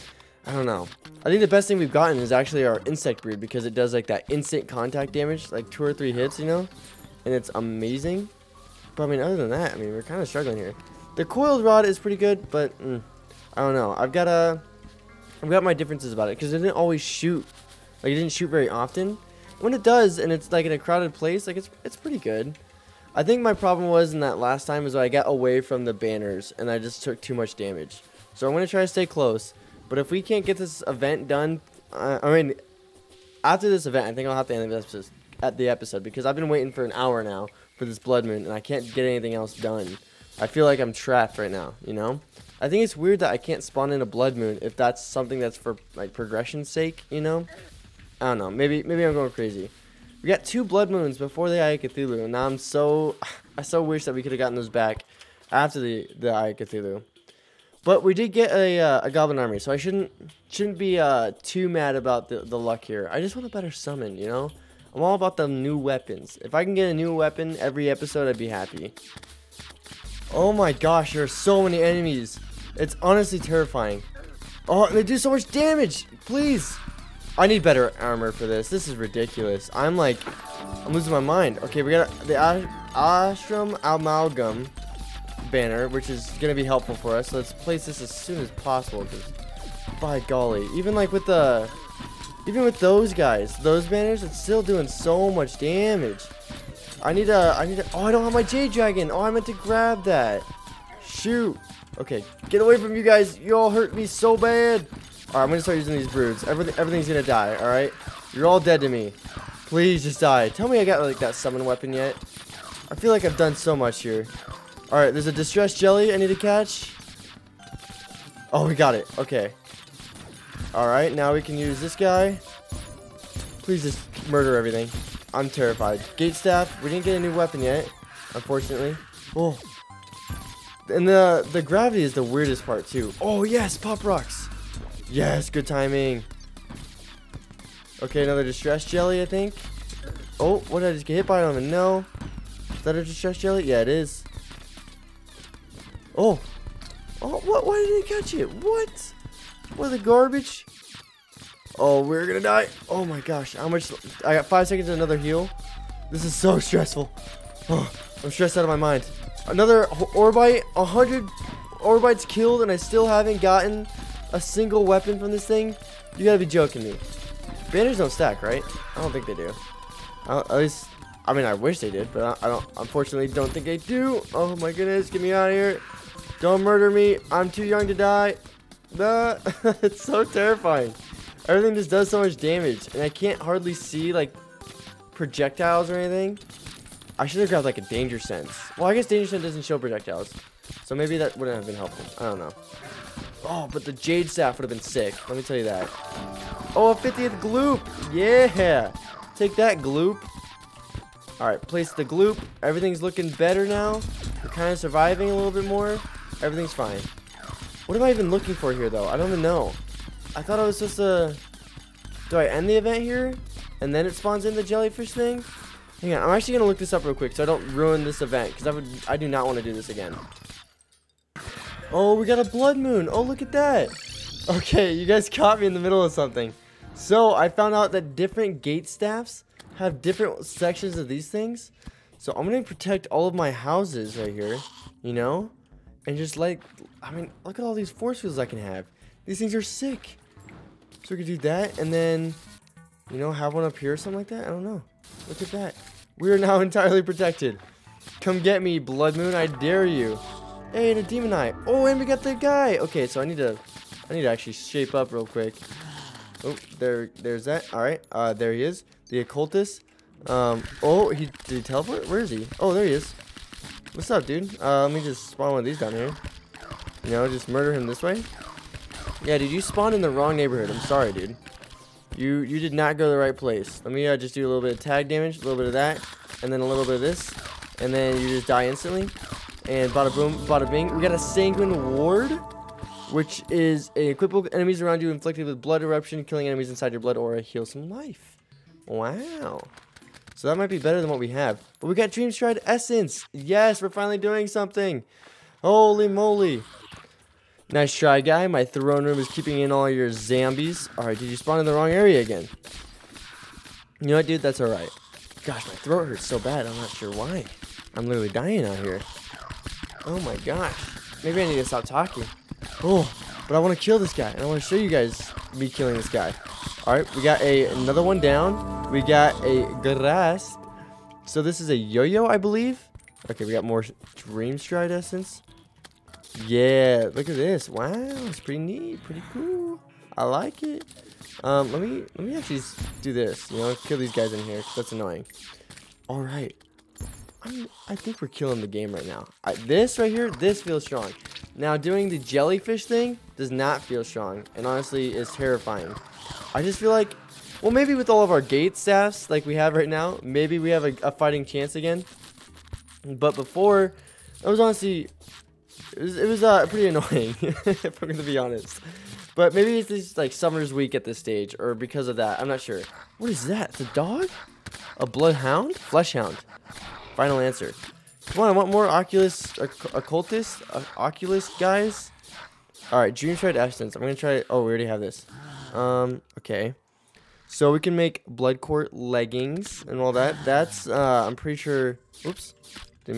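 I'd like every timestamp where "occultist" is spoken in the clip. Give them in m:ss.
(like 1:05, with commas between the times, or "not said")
4:19, 6:09.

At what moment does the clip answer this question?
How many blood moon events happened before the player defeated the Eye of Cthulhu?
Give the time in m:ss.
0:50.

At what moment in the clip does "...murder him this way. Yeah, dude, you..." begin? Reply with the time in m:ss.
4:27.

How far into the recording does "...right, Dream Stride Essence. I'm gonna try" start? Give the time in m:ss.
6:12.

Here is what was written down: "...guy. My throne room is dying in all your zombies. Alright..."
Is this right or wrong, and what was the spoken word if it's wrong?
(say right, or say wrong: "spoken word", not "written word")
wrong: "keeping", not "dying".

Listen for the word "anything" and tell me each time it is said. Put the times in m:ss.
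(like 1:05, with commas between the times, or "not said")
0:39, 3:05.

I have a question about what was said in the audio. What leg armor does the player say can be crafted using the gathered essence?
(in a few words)
blood court leggings.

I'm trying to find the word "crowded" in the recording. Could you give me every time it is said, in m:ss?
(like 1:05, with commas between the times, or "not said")
0:20.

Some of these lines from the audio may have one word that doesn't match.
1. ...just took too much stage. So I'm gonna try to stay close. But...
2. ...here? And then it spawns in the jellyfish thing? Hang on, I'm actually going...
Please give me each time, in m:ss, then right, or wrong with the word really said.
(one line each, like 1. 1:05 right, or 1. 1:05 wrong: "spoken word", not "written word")
1. 0:26 wrong: "damage", not "stage"
2. 3:33 right.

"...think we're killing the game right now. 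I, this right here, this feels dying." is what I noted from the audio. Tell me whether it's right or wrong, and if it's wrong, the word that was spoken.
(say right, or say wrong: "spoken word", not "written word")
wrong: "strong", not "dying".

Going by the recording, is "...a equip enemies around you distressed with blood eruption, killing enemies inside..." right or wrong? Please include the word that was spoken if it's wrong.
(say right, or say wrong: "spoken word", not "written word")
wrong: "inflicted", not "distressed".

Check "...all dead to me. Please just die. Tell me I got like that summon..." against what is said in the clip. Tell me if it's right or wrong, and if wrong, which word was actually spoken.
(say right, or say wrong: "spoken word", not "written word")
right.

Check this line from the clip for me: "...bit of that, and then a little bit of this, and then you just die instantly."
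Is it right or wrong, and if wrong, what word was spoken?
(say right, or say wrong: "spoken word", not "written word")
right.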